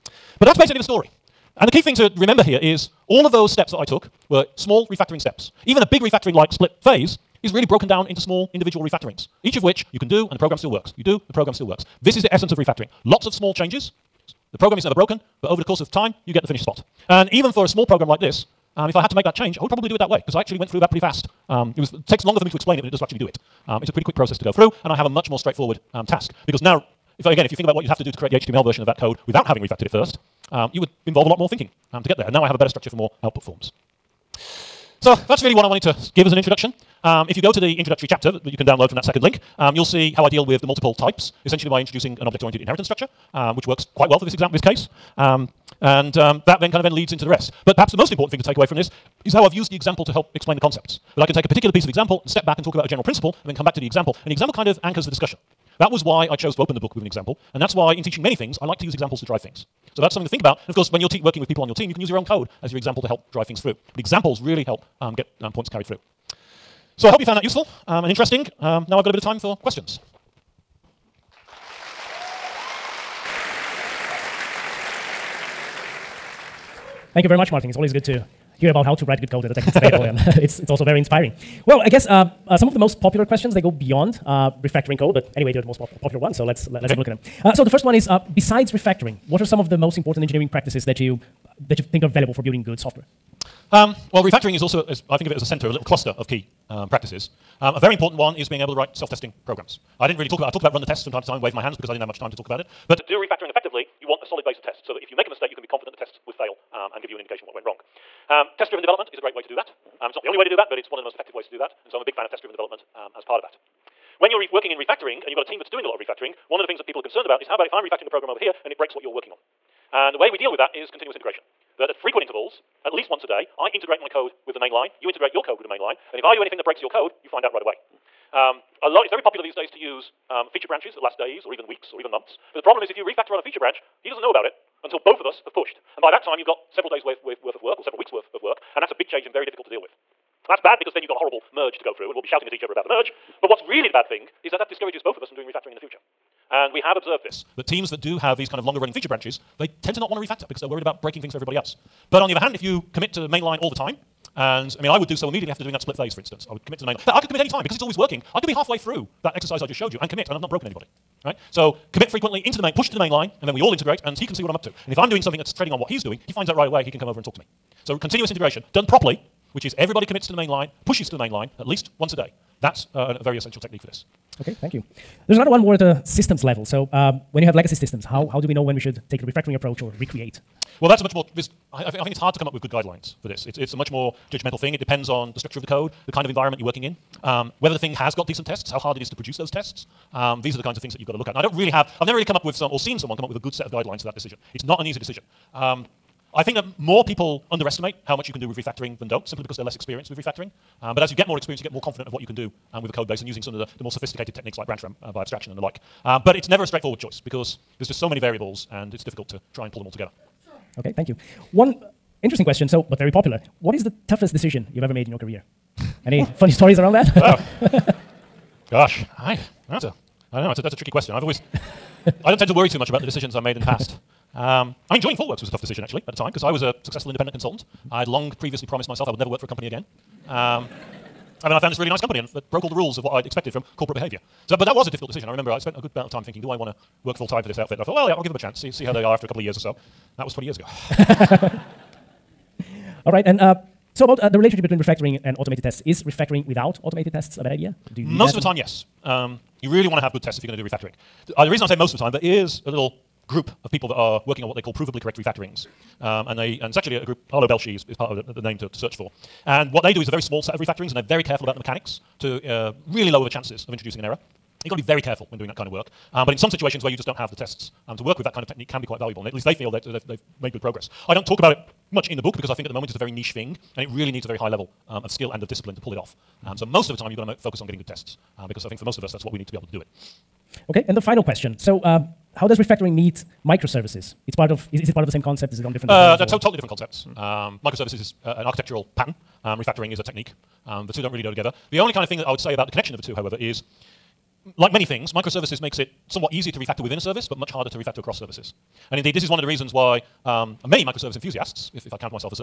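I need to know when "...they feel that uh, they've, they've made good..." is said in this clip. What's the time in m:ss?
4:29.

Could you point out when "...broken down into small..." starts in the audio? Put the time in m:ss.
0:07.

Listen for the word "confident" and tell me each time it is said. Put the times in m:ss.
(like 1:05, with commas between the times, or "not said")
1:45, 3:21.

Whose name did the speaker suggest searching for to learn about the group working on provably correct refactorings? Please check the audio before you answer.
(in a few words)
Arlo Belshee.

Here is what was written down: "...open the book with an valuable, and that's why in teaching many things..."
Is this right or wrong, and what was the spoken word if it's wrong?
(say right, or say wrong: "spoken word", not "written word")
wrong: "example", not "valuable".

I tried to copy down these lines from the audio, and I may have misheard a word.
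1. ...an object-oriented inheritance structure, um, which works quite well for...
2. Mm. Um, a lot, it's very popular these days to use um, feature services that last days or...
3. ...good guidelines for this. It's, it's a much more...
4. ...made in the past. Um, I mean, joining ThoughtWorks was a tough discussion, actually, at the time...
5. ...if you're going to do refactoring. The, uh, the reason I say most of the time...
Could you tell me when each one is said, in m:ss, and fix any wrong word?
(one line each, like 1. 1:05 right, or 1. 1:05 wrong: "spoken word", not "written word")
1. 0:42 right
2. 2:07 wrong: "branches", not "services"
3. 3:02 right
4. 3:43 wrong: "decision", not "discussion"
5. 4:10 right.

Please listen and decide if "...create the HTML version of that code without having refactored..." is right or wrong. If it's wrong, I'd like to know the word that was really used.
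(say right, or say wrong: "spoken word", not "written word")
right.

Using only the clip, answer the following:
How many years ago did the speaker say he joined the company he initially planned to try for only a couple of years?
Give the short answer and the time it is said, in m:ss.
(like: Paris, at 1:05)
20, at 4:00.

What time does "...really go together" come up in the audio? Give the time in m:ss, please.
4:51.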